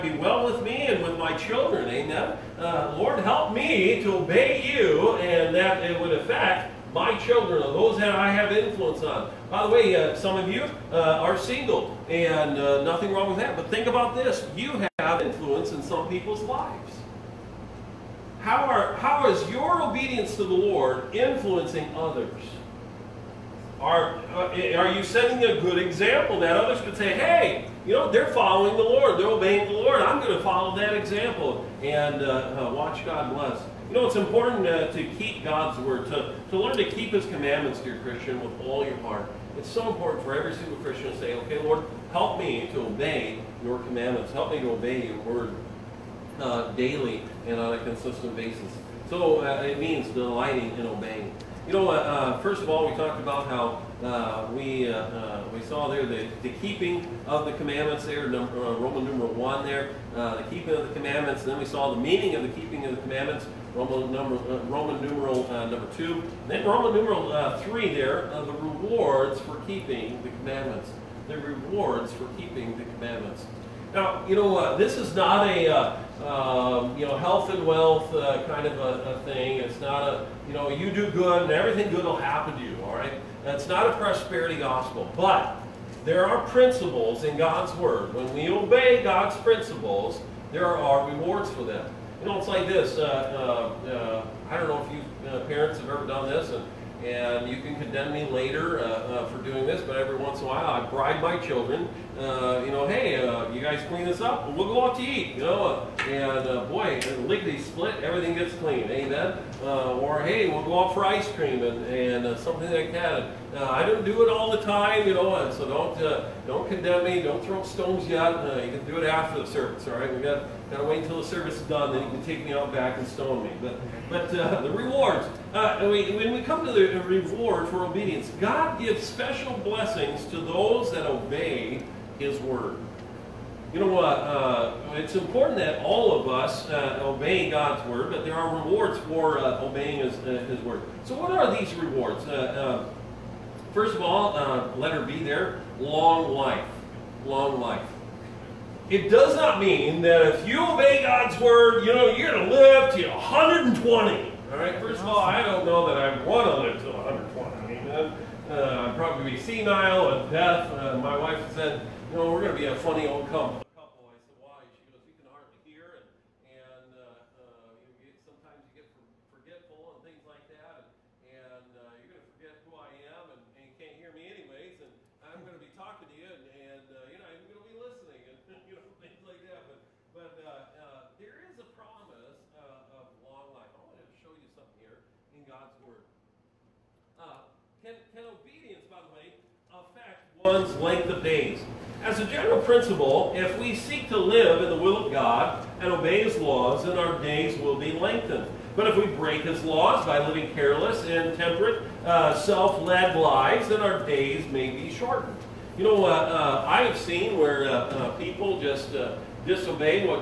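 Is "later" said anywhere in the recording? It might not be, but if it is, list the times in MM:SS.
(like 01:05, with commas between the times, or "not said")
01:38.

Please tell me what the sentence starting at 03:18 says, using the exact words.
But if we break his laws by living careless, and uh, self-led lives, then our days may be shortened.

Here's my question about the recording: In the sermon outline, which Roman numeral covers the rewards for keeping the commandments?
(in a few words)
3.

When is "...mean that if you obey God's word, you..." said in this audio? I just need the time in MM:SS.
02:29.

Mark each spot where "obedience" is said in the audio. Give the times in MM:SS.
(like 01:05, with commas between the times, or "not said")
00:19, 02:07, 03:08.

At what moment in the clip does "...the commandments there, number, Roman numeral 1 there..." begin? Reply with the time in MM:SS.
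00:57.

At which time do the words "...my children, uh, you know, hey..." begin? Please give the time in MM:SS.
01:41.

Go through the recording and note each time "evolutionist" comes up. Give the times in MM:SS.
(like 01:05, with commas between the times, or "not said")
not said.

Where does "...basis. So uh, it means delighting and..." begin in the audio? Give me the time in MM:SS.
00:48.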